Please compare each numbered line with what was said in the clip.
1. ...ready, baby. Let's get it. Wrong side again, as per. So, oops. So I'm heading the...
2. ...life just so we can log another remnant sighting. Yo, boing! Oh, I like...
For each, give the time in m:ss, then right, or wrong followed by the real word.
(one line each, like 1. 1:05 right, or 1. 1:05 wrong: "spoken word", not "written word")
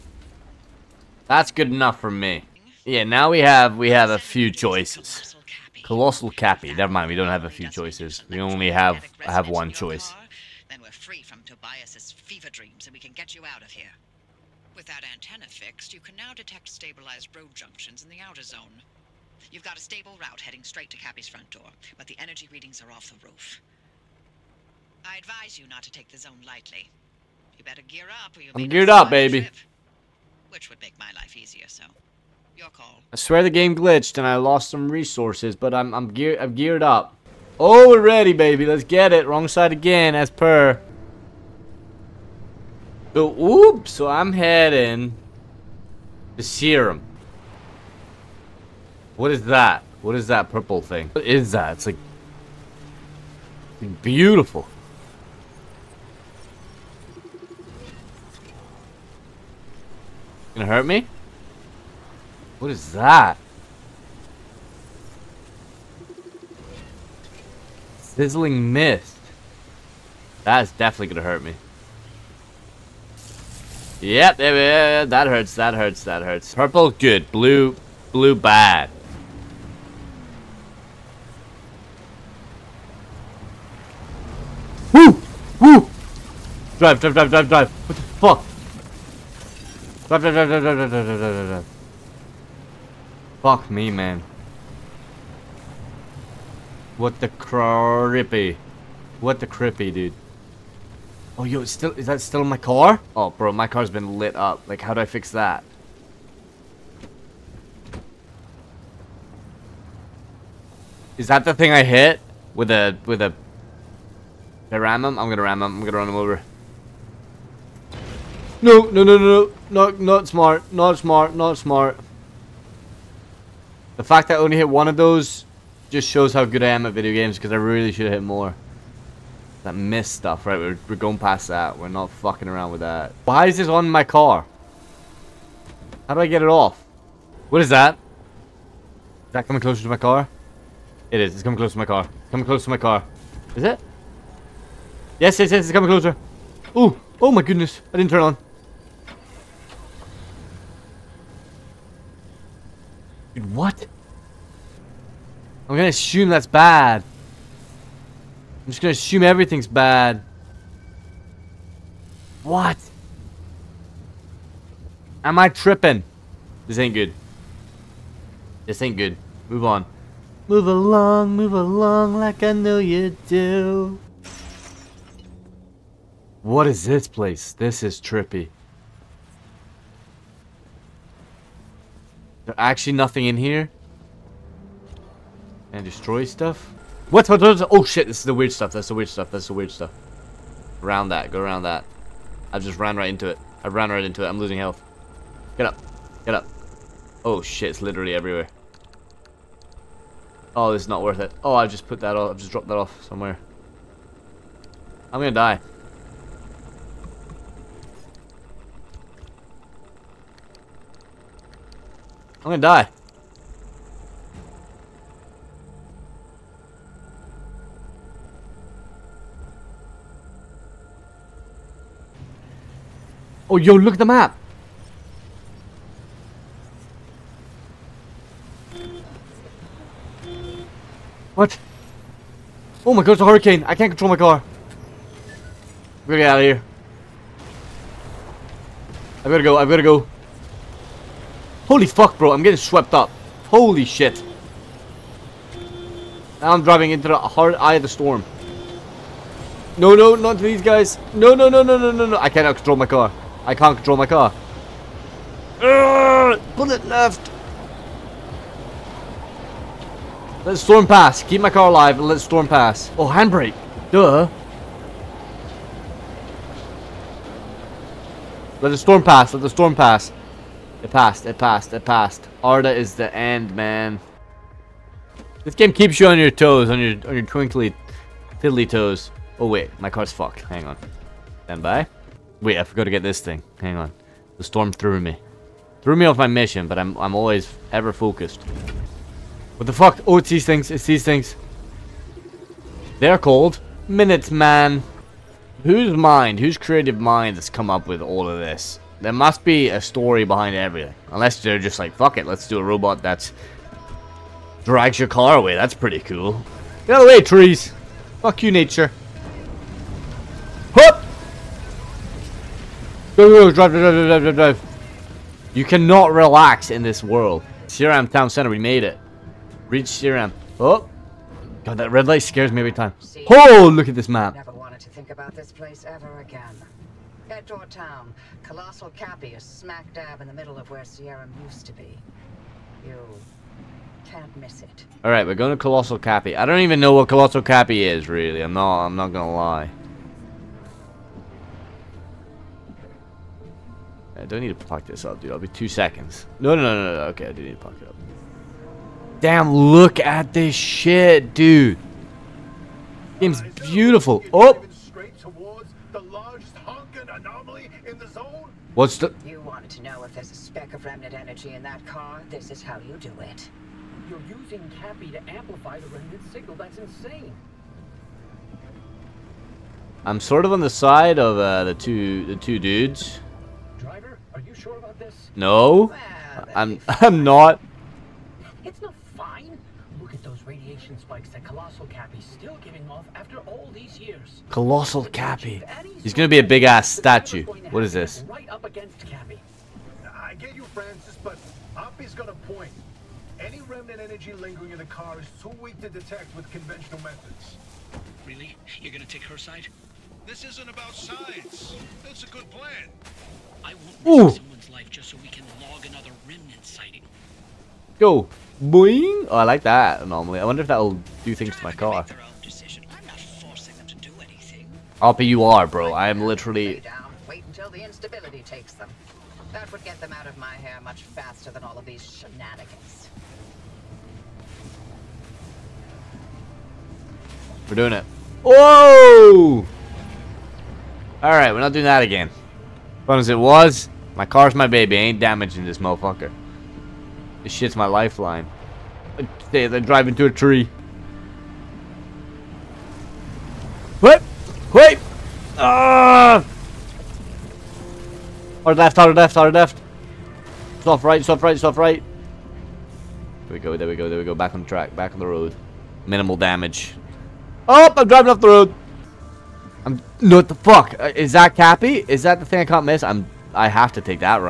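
1. 0:38 right
2. 6:44 right.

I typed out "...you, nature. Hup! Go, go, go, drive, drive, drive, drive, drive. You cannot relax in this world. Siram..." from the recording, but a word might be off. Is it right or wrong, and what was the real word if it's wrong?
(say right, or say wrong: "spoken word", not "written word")
right.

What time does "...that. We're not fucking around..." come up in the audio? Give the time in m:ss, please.
2:11.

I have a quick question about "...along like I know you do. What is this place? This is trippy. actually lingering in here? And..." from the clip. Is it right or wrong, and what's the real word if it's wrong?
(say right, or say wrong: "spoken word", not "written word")
wrong: "nothing", not "lingering".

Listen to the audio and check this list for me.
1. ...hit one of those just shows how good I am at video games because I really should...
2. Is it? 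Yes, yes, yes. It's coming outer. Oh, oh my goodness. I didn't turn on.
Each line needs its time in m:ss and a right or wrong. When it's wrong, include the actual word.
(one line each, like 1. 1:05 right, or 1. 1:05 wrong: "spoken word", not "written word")
1. 2:04 right
2. 2:23 wrong: "closer", not "outer".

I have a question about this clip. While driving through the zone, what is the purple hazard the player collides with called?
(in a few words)
Sizzling mist.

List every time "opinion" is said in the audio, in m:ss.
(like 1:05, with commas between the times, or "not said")
not said.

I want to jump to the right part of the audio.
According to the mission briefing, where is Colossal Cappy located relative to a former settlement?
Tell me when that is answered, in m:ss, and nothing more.
5:30.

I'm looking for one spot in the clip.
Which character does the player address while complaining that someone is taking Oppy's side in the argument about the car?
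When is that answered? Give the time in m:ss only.
6:30.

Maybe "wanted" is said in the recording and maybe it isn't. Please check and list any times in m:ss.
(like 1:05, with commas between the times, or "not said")
5:24, 5:59.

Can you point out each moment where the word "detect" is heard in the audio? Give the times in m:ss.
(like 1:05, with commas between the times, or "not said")
0:16, 6:35.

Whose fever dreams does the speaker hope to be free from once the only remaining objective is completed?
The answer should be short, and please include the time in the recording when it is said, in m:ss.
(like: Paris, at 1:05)
Tobias, at 0:11.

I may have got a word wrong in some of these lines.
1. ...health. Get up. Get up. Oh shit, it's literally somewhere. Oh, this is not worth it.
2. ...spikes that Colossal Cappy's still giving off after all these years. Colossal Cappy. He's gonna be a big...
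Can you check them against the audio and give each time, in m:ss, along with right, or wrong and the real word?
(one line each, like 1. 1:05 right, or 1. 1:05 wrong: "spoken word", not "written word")
1. 3:14 wrong: "everywhere", not "somewhere"
2. 6:20 right.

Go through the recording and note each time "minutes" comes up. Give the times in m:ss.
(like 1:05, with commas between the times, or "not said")
4:53.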